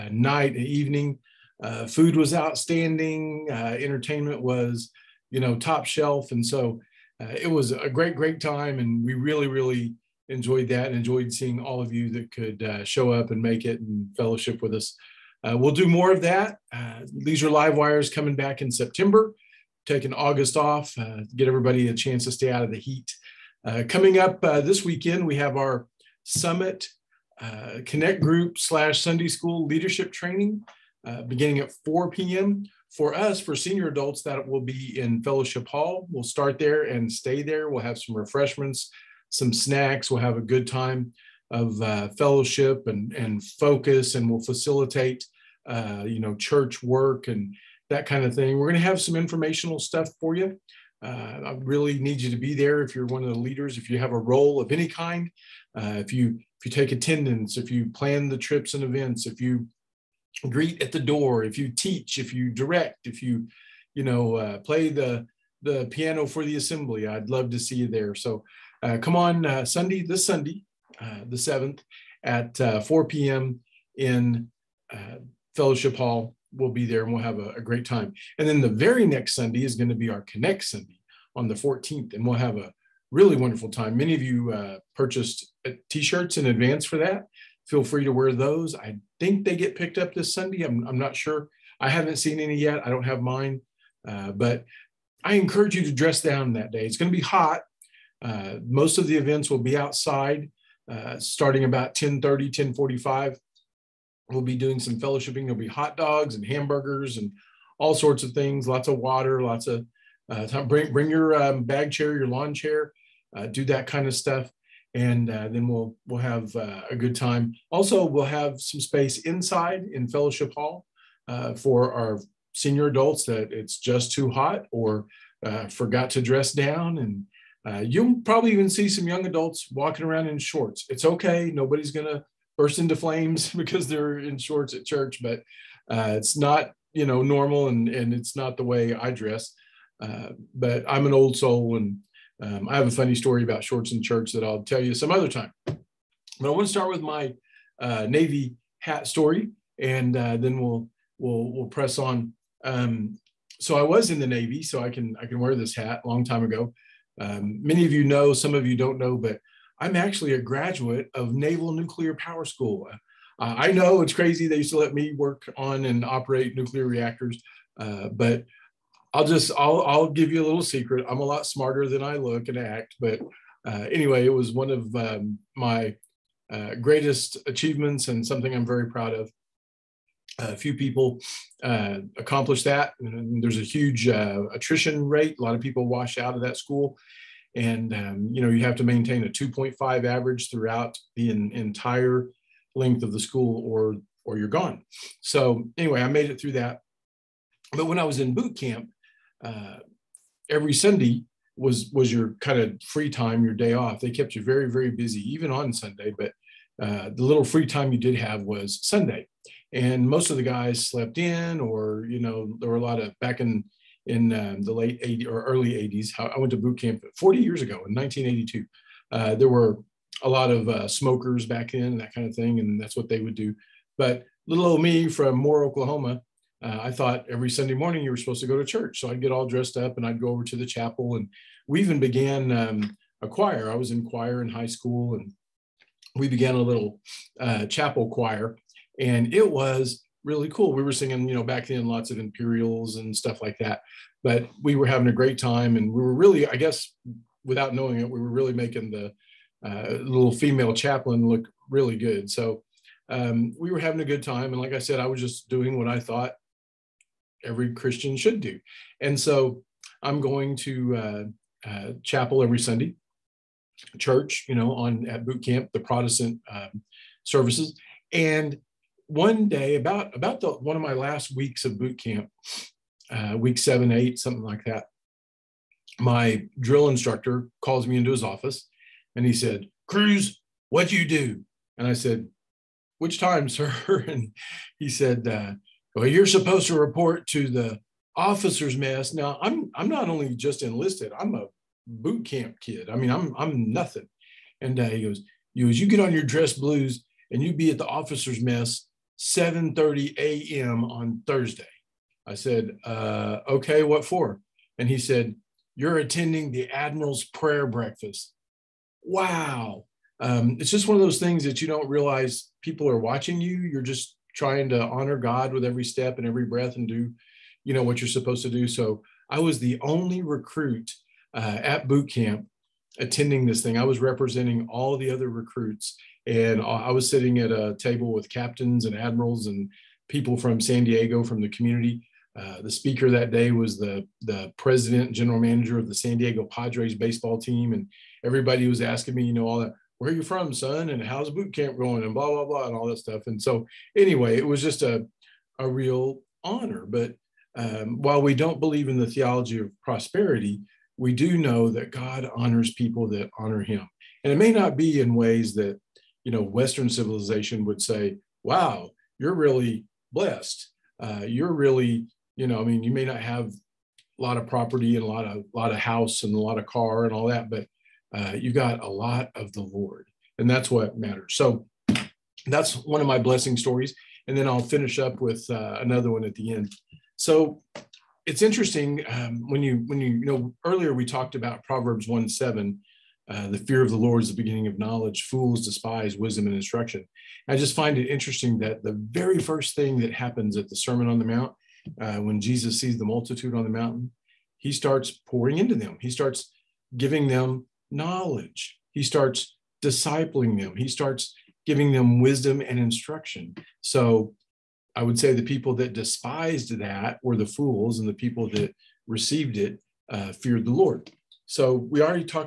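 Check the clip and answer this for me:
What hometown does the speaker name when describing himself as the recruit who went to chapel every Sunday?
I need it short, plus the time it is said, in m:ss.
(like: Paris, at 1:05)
Moore, Oklahoma, at 3:45.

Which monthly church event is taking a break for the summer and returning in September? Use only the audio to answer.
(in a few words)
Leisure Live Wire.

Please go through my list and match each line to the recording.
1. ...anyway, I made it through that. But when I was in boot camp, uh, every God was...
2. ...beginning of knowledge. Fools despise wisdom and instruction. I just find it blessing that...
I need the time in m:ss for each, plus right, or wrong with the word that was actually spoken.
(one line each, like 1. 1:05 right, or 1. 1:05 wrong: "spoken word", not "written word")
1. 3:15 wrong: "Sunday", not "God"
2. 6:24 wrong: "interesting", not "blessing".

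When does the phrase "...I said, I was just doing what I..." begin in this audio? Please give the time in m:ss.
4:14.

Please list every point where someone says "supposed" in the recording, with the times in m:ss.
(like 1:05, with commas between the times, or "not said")
3:48, 4:46, 5:18.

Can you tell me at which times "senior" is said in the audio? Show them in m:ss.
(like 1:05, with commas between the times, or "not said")
0:33, 2:02.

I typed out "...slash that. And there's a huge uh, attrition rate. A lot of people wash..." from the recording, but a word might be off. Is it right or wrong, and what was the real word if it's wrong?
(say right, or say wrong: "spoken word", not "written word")
wrong: "accomplish", not "slash".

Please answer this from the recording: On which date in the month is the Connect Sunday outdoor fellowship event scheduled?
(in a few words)
14th.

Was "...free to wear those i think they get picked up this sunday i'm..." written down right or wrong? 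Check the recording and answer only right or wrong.
right.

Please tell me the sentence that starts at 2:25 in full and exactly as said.
But I want to start with my uh, Navy hat story, and uh, then we'll we'll we'll press on.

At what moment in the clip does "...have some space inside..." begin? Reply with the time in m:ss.
1:58.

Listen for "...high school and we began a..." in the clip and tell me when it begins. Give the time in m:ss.
3:54.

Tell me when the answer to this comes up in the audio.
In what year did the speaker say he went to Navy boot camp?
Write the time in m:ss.
3:37.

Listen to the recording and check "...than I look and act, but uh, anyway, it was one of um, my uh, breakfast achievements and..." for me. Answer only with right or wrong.
wrong.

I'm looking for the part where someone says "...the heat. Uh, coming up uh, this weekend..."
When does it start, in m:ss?
0:22.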